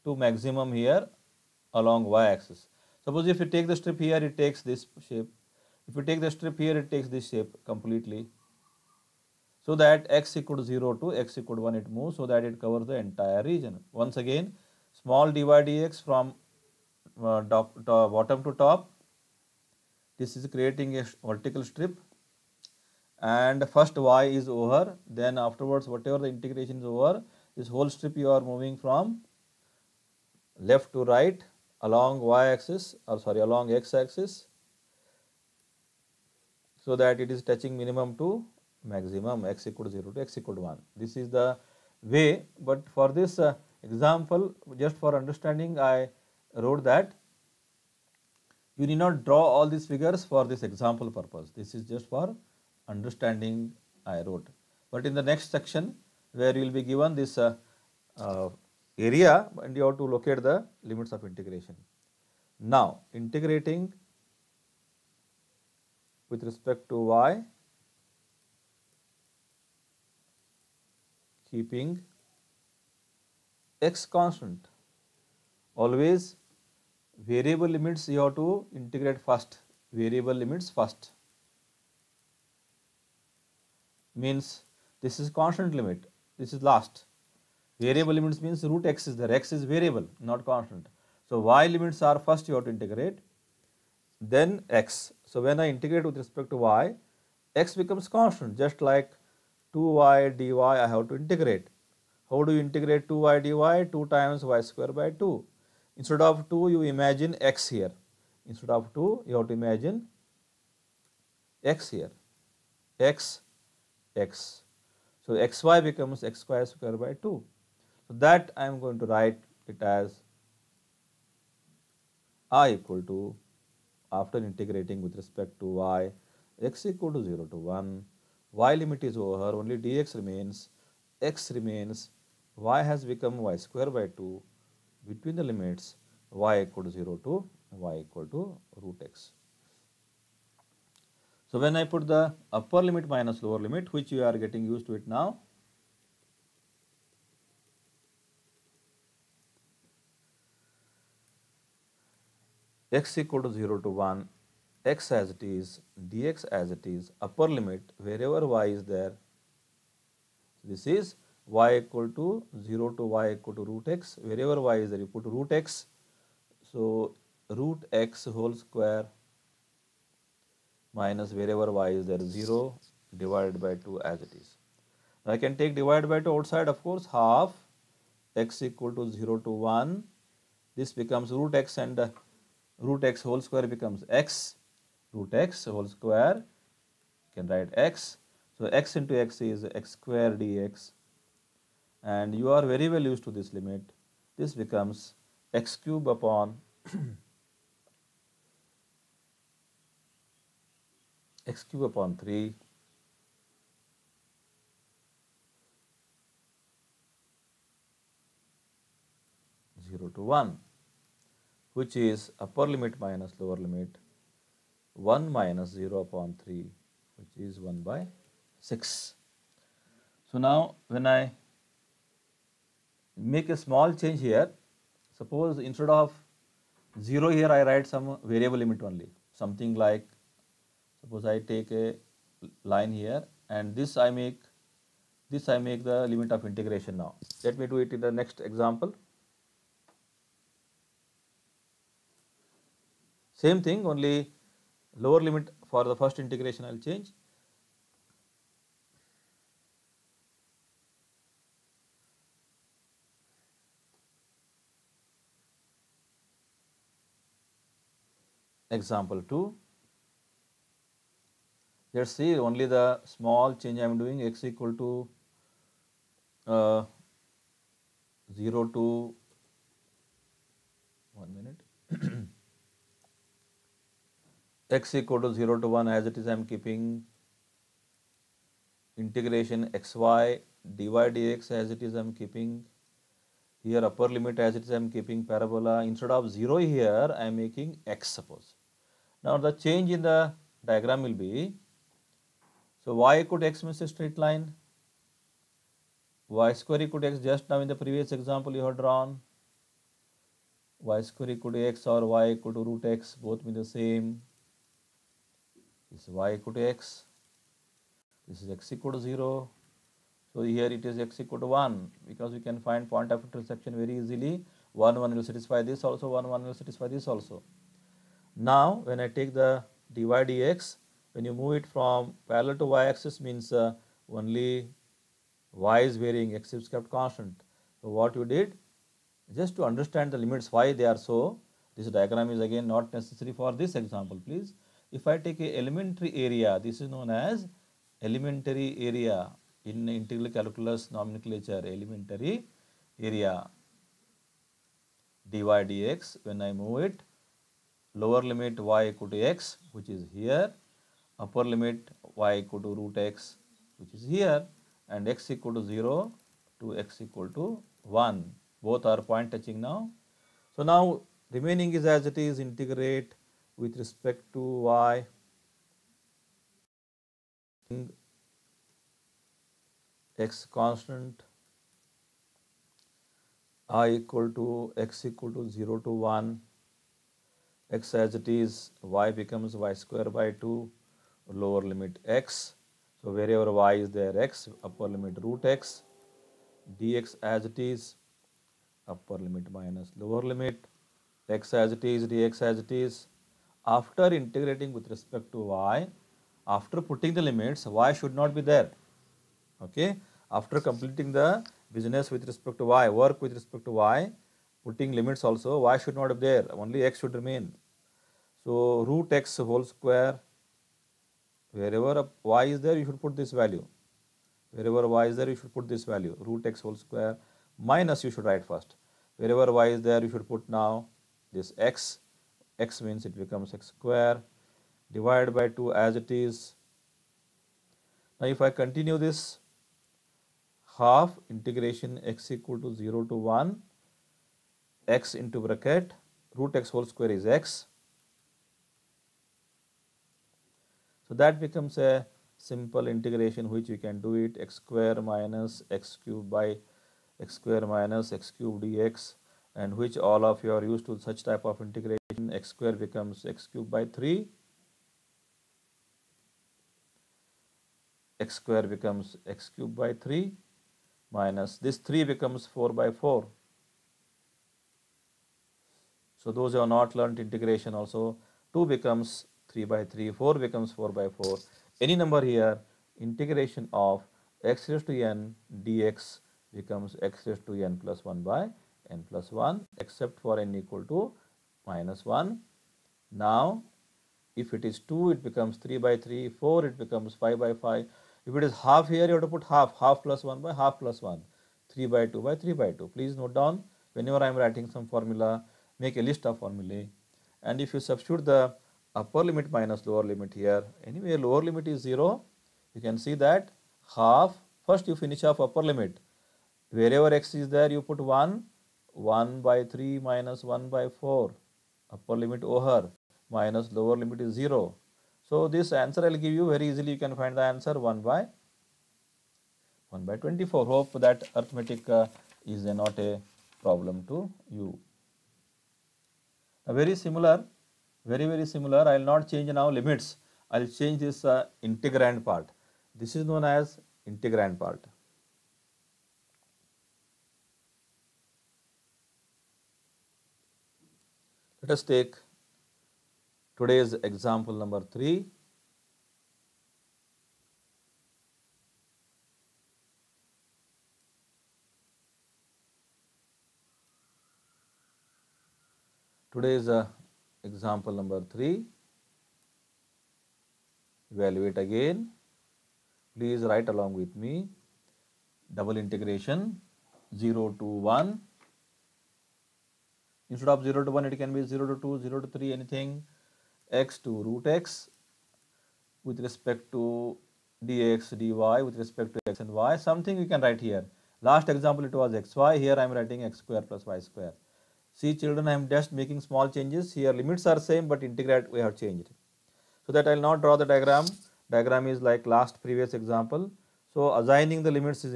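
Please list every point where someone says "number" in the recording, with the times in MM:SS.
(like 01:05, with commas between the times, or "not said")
07:52, 09:04, 09:17.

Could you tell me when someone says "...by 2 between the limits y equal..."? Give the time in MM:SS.
02:13.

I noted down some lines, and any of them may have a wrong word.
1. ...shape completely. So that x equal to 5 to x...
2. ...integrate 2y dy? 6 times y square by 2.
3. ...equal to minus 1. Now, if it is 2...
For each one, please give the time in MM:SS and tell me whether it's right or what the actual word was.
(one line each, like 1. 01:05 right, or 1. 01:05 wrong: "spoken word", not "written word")
1. 00:07 wrong: "0", not "5"
2. 01:42 wrong: "2", not "6"
3. 08:00 right.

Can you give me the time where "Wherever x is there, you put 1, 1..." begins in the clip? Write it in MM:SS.
08:26.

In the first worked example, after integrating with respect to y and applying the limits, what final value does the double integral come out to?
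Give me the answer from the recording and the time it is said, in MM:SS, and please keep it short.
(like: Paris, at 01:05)
1/6, at 03:37.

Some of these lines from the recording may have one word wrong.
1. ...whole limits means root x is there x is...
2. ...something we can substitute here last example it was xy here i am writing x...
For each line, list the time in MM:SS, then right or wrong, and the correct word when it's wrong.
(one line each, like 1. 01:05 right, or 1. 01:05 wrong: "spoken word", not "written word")
1. 01:27 wrong: "variable", not "whole"
2. 09:39 wrong: "write", not "substitute".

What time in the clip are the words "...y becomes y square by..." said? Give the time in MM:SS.
06:18.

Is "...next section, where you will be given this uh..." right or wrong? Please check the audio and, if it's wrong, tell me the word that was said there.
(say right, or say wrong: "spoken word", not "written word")
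right.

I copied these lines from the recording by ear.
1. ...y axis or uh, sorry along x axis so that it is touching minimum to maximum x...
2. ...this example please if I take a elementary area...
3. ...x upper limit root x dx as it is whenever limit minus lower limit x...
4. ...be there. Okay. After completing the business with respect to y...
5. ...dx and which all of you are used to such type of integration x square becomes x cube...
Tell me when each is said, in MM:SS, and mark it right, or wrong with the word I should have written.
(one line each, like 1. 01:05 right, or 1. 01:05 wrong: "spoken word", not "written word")
1. 00:32 right
2. 05:33 right
3. 06:24 wrong: "upper", not "whenever"
4. 06:38 right
5. 07:28 right.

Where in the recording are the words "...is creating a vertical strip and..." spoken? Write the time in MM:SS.
00:20.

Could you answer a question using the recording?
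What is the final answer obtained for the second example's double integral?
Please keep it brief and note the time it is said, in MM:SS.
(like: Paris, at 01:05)
1/24, at 08:39.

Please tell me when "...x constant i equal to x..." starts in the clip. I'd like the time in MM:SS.
06:10.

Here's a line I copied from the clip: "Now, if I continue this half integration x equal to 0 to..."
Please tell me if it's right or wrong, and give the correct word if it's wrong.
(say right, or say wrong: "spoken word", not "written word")
right.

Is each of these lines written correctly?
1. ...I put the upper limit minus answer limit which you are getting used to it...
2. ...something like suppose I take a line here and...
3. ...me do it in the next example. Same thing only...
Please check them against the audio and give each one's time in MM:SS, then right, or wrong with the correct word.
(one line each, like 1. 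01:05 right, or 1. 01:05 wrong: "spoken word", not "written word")
1. 02:21 wrong: "lower", not "answer"
2. 03:49 right
3. 03:57 right.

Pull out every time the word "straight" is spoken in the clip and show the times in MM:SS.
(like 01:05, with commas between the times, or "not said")
04:53.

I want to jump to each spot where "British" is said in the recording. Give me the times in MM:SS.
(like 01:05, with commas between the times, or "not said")
not said.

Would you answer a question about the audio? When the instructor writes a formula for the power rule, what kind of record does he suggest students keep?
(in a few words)
list of formulae.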